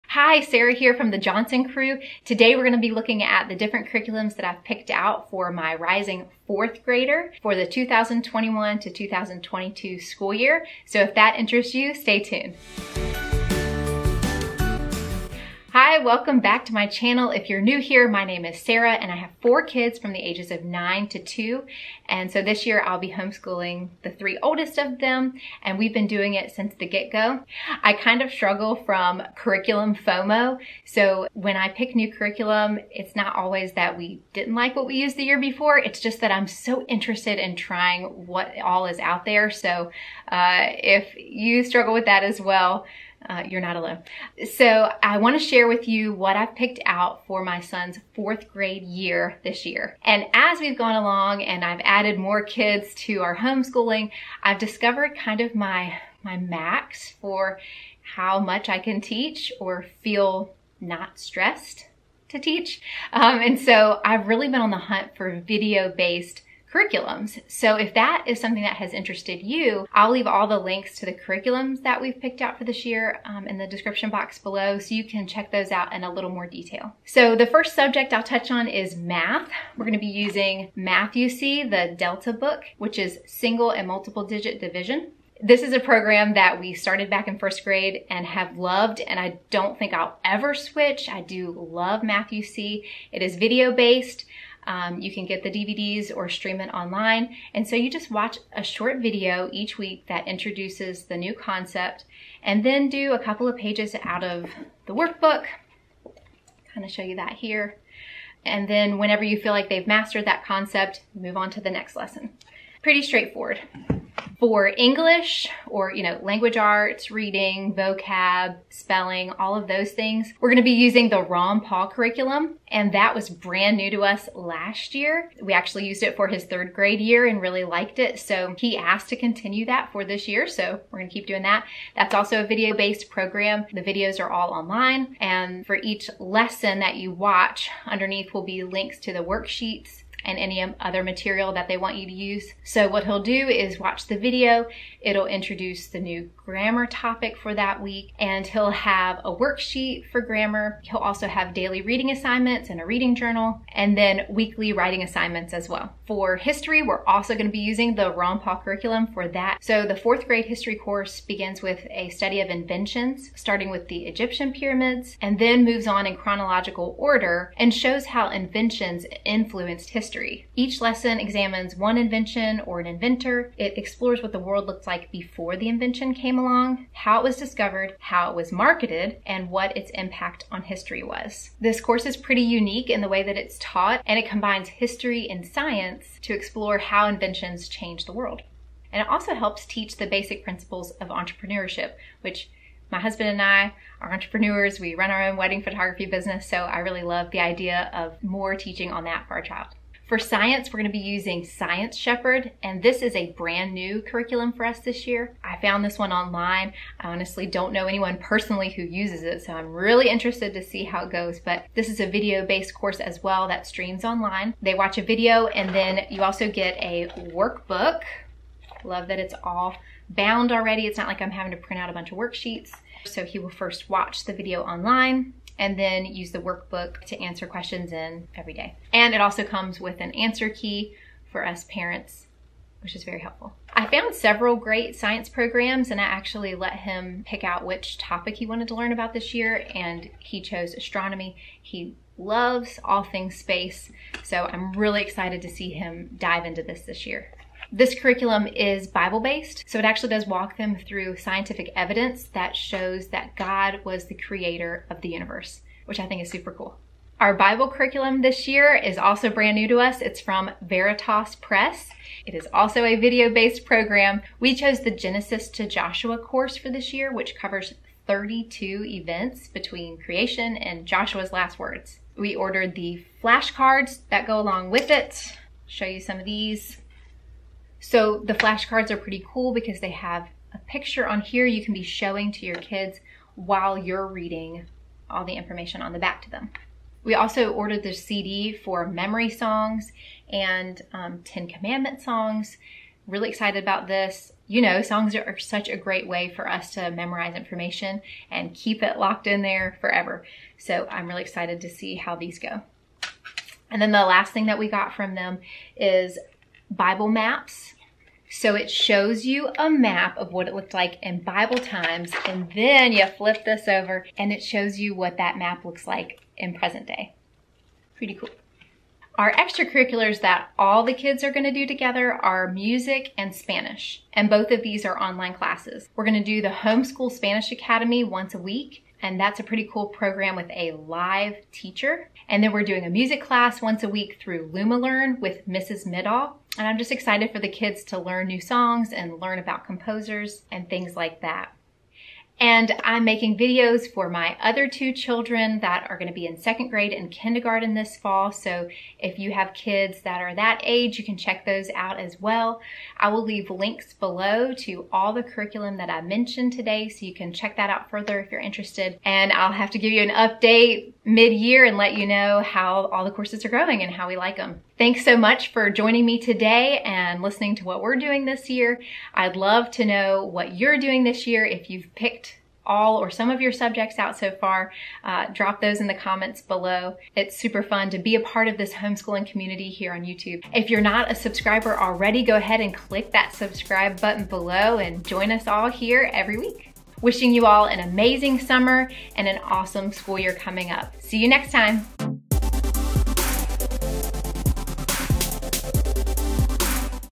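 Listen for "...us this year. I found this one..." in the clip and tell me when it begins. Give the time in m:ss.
3:24.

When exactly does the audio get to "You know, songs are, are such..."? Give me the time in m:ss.
4:54.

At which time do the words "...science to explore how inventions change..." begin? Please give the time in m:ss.
3:05.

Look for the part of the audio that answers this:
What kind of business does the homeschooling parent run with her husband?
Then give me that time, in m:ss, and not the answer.
3:15.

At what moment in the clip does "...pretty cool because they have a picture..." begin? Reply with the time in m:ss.
4:38.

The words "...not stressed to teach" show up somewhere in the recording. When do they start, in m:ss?
1:00.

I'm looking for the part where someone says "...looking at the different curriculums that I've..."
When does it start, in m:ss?
0:02.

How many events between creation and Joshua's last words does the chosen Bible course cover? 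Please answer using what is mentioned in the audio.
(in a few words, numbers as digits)
32.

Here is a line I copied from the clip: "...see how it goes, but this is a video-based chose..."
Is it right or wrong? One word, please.
wrong.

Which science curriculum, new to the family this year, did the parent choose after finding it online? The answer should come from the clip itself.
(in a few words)
Science Shepherd.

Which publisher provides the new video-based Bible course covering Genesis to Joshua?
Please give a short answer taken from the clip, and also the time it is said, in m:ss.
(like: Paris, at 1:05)
Veritas Press, at 4:20.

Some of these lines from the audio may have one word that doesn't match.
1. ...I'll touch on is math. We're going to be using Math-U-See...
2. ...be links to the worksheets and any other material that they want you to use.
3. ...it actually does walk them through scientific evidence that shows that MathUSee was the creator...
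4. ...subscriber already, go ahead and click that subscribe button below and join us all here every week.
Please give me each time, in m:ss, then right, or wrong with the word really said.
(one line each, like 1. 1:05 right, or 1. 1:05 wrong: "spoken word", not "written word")
1. 1:18 right
2. 2:18 right
3. 4:09 wrong: "God", not "MathUSee"
4. 6:21 right.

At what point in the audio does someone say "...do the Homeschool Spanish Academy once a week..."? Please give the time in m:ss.
5:26.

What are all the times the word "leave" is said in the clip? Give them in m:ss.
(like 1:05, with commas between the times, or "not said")
1:10, 5:53.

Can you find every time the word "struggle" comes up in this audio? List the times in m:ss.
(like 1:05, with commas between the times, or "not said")
0:28, 0:41.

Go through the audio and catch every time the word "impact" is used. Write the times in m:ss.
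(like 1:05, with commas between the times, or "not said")
2:59.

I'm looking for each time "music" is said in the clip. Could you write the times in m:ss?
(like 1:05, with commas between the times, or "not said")
5:22, 5:32.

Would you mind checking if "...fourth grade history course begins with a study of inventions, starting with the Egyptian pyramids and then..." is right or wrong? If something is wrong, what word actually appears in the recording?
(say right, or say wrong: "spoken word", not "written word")
right.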